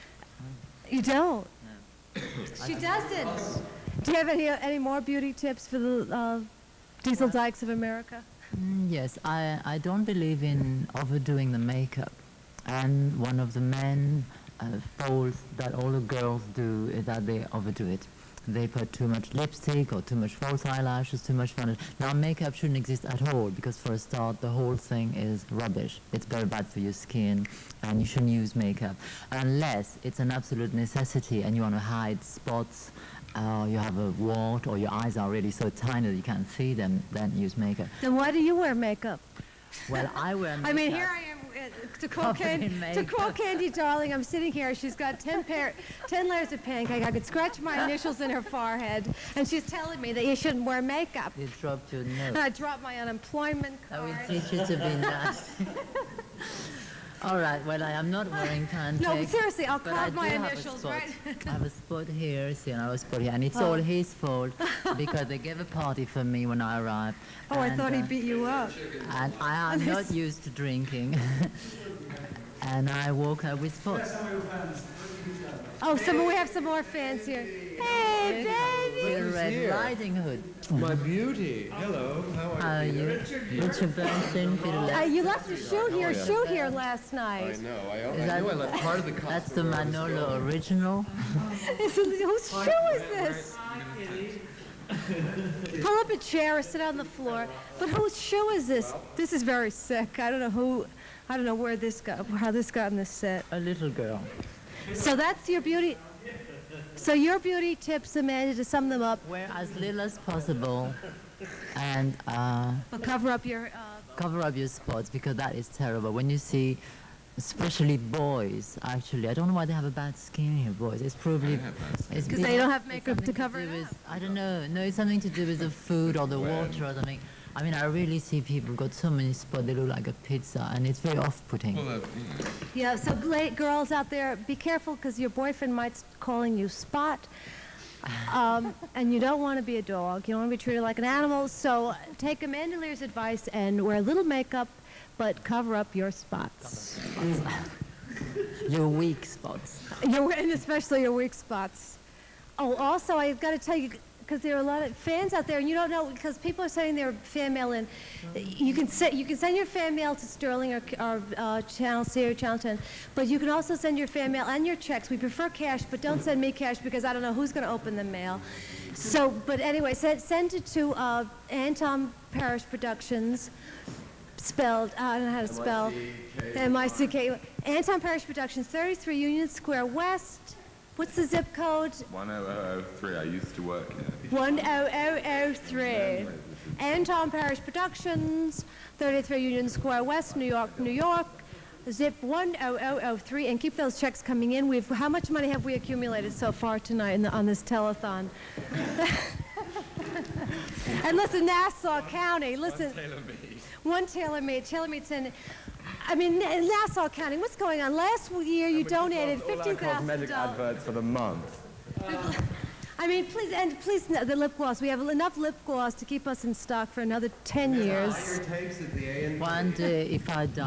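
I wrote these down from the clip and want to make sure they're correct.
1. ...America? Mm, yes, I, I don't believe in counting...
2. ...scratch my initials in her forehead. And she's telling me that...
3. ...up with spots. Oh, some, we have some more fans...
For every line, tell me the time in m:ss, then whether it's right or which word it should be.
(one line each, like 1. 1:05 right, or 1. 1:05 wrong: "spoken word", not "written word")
1. 0:07 wrong: "overdoing", not "counting"
2. 0:47 right
3. 1:13 right.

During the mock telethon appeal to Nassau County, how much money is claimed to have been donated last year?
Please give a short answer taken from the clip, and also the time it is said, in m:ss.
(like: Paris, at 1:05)
$50,000, at 3:29.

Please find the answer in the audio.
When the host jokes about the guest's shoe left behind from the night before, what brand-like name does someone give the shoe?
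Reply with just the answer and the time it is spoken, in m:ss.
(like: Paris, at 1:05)
Manolo, at 1:29.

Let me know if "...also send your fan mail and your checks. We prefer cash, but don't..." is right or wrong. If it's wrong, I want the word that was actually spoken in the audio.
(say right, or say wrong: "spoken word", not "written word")
right.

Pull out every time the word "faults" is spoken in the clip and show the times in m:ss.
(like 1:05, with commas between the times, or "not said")
0:14, 1:04.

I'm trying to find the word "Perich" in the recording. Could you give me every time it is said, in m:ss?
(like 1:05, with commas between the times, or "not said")
2:52, 2:57, 3:07.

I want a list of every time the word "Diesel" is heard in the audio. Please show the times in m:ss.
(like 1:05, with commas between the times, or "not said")
0:07.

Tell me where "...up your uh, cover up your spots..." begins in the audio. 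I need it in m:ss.
1:53.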